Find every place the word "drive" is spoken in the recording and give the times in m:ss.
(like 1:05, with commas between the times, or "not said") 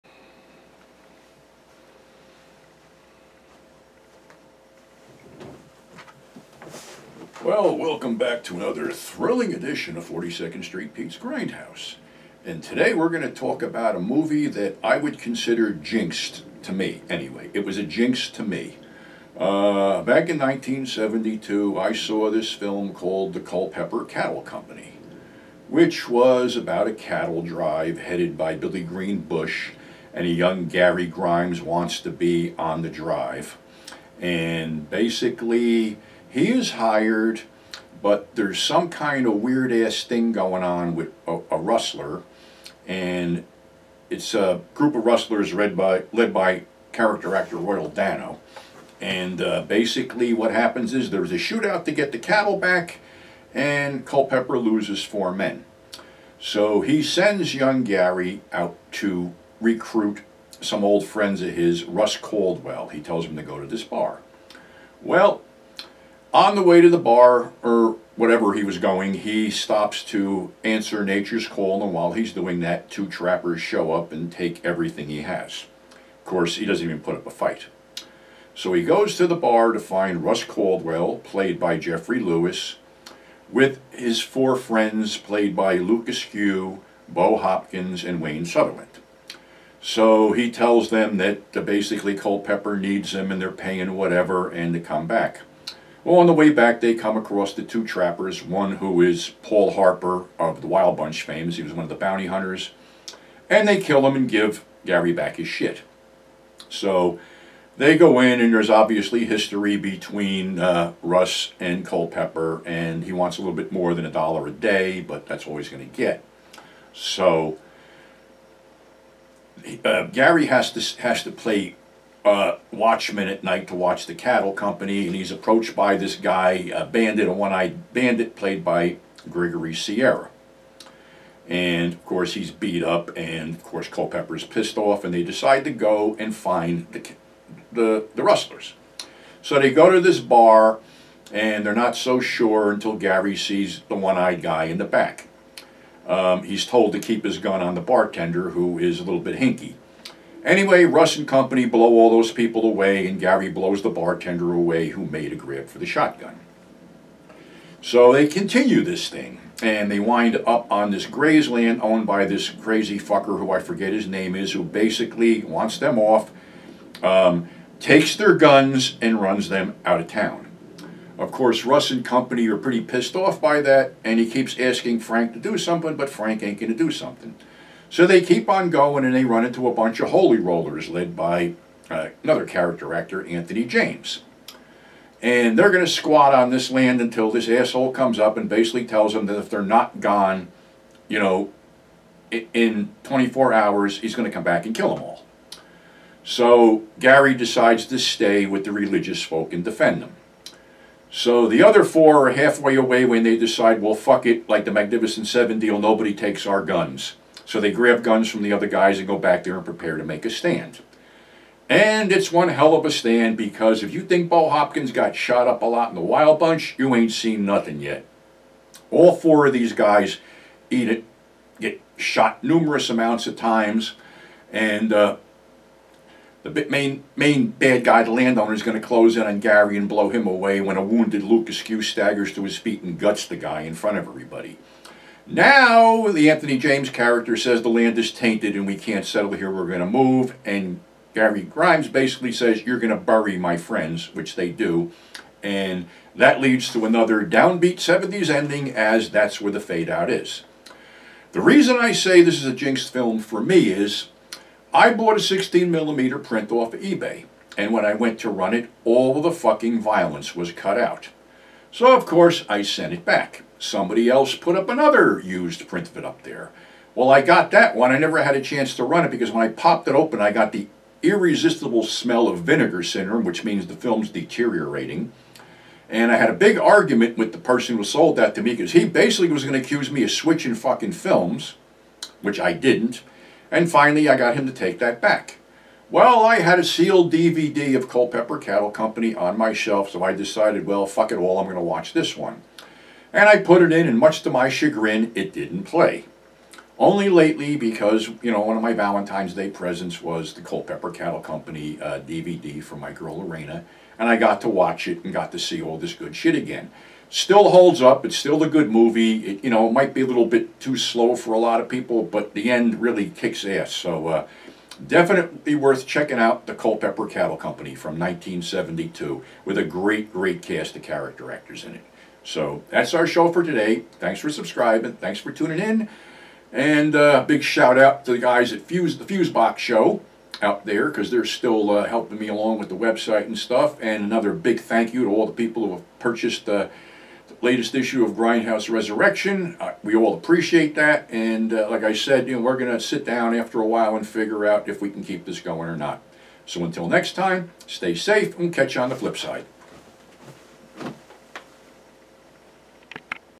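0:27, 0:32.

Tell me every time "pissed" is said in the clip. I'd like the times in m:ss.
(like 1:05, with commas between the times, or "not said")
2:14, 2:52.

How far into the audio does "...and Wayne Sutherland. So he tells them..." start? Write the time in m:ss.
1:28.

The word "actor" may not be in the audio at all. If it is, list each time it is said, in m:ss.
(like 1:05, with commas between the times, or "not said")
0:47, 3:02, 5:21.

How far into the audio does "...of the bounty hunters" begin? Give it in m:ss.
1:41.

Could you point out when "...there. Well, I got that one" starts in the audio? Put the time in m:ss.
4:26.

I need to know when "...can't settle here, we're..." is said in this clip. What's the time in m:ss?
3:58.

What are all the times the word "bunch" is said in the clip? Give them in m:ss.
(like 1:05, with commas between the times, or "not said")
1:40, 2:59, 3:36.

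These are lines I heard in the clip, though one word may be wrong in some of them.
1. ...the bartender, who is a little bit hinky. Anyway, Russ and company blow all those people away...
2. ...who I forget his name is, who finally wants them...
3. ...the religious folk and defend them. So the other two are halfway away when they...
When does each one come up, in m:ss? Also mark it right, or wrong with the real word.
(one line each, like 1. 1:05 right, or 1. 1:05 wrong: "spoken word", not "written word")
1. 2:27 right
2. 2:43 wrong: "basically", not "finally"
3. 3:18 wrong: "four", not "two".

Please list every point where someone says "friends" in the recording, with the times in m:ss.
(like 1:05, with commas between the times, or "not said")
1:01, 1:24, 4:03.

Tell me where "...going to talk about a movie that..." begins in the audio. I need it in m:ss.
0:13.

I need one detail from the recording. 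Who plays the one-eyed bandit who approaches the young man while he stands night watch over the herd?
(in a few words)
Gregory Sierra.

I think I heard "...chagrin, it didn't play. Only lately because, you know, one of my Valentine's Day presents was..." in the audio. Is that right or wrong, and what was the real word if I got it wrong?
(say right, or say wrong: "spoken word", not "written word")
right.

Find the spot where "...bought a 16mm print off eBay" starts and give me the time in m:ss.
4:14.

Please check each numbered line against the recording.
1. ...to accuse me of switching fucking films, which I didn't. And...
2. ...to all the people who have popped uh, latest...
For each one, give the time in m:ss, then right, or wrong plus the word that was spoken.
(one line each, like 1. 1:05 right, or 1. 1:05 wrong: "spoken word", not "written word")
1. 4:39 right
2. 5:35 wrong: "purchased", not "popped".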